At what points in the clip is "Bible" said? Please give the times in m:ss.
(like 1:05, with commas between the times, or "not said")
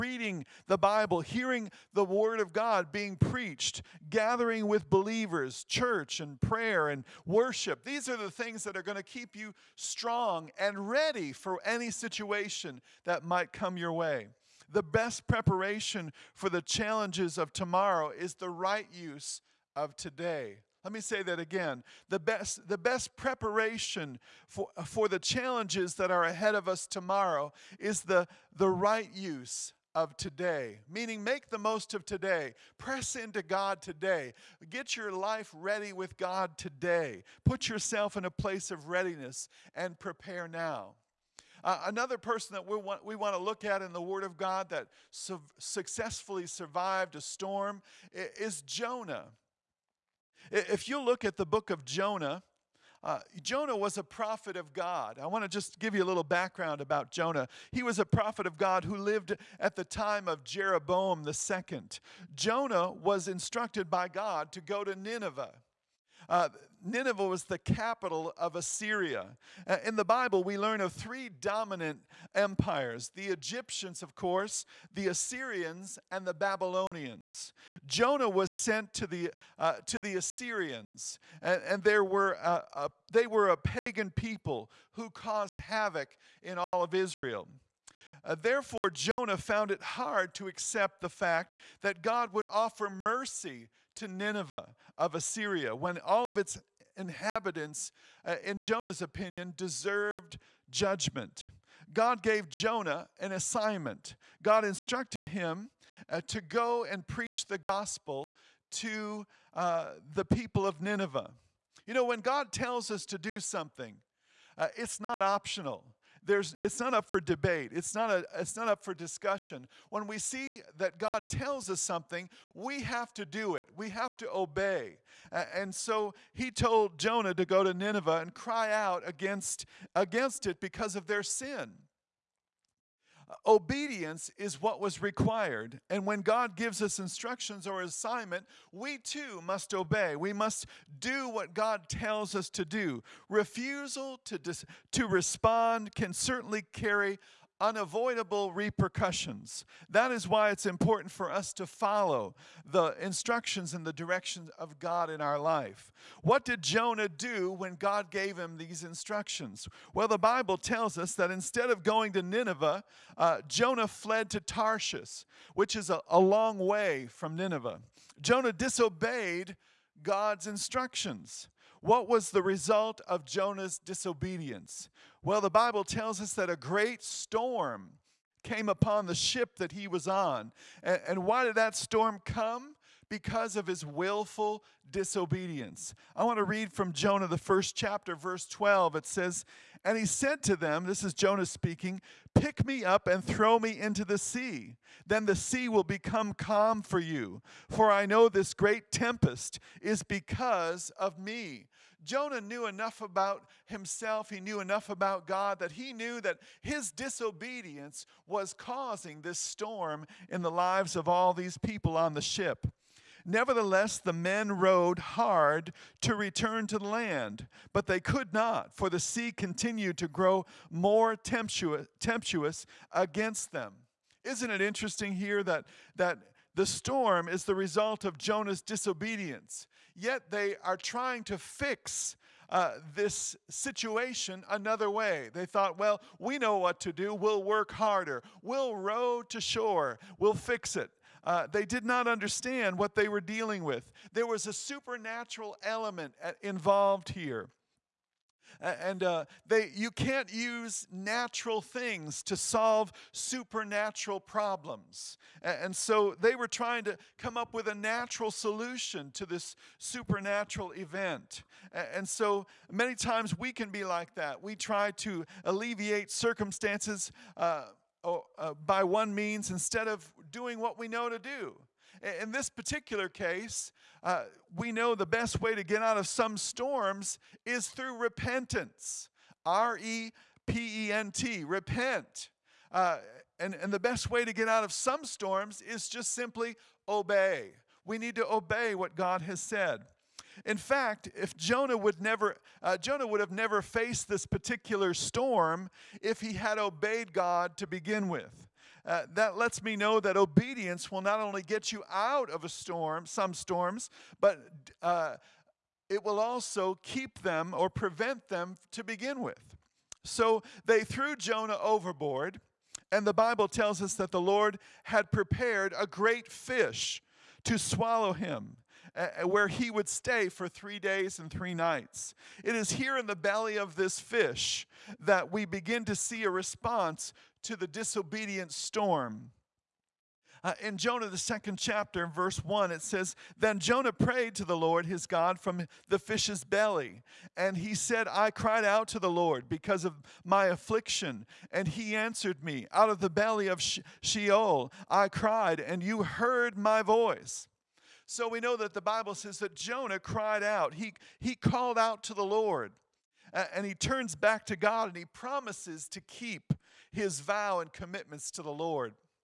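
0:00, 1:10, 2:40, 2:55, 5:13, 5:48.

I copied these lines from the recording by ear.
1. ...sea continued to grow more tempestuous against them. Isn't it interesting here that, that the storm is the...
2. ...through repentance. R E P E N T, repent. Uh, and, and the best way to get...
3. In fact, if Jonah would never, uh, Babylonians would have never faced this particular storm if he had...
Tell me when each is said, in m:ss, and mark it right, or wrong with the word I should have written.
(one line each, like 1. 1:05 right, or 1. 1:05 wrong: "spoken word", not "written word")
1. 3:38 right
2. 4:37 right
3. 4:50 wrong: "Jonah", not "Babylonians".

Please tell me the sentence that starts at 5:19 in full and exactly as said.
where he would stay for three days and three nights.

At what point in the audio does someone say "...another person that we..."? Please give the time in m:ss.
0:41.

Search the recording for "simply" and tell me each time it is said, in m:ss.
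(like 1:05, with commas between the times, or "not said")
4:46.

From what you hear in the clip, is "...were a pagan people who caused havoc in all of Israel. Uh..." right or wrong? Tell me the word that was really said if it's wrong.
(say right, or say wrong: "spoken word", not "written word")
right.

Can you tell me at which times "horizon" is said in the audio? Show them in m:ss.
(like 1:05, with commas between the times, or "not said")
not said.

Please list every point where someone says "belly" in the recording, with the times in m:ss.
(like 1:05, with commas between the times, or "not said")
5:23, 5:36, 5:43.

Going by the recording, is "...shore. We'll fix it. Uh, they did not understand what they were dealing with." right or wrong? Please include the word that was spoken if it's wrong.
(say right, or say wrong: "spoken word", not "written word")
right.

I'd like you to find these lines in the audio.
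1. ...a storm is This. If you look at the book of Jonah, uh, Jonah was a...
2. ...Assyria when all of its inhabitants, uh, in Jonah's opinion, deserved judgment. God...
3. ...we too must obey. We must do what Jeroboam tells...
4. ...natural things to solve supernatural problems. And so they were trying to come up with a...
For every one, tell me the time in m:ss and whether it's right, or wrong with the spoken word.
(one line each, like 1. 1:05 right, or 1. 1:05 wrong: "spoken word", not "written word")
1. 0:47 wrong: "Jonah", not "This"
2. 1:35 right
3. 2:18 wrong: "God", not "Jeroboam"
4. 4:10 right.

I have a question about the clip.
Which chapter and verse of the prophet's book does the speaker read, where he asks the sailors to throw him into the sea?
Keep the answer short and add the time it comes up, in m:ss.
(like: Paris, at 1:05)
Chapter 1, verse 12, at 3:07.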